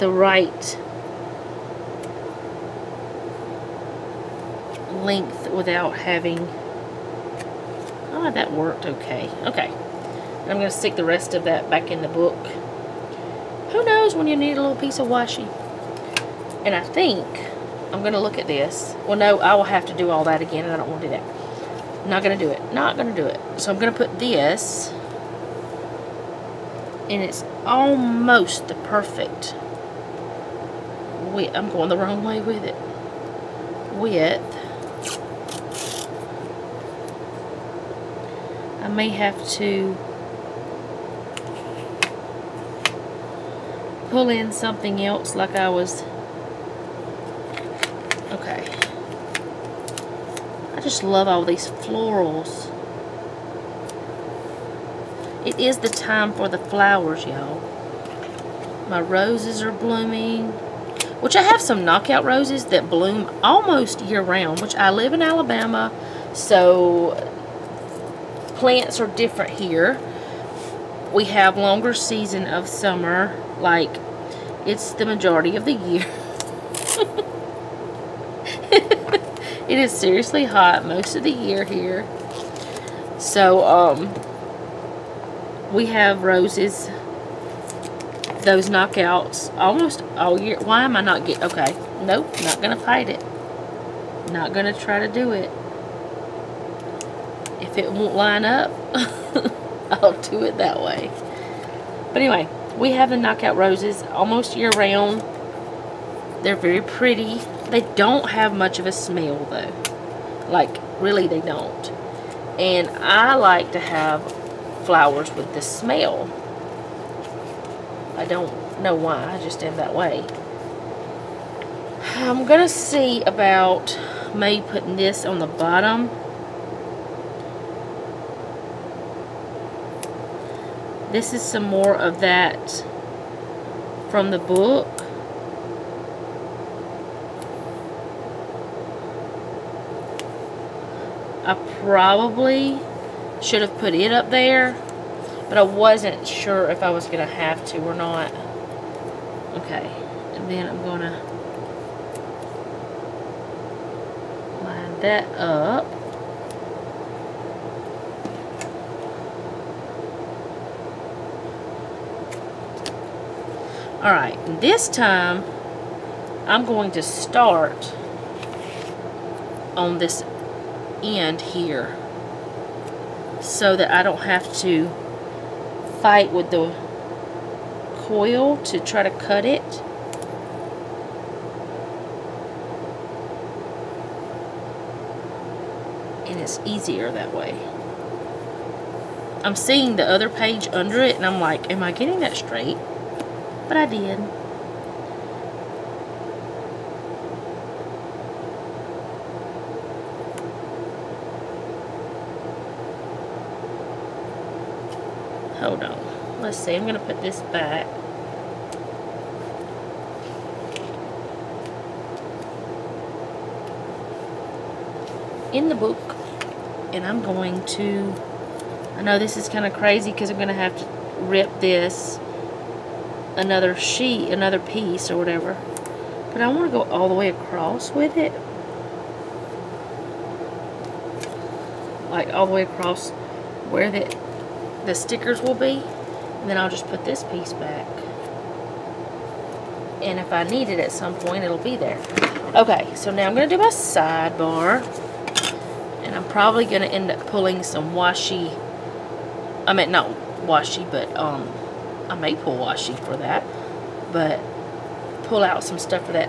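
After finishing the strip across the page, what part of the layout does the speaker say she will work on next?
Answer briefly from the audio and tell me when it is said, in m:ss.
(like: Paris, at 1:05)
Sidebar, at 4:03.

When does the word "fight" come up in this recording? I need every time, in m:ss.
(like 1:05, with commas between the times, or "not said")
1:32, 2:56.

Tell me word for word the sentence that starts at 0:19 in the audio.
Well, no, I will have to do all that again, and I don't want to do that.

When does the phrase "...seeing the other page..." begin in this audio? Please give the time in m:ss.
3:09.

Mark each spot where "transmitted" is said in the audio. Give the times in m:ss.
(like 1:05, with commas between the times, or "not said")
not said.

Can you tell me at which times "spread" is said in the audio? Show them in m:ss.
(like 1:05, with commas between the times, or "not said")
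not said.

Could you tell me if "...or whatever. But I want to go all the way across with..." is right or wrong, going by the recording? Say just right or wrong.
right.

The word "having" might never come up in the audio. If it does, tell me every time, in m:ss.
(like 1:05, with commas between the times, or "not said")
0:05.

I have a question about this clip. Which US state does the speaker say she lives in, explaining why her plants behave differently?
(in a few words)
Alabama.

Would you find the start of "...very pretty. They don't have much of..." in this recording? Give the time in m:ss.
1:46.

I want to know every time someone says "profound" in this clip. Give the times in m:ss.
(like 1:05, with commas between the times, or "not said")
not said.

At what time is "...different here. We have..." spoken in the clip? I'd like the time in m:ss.
1:09.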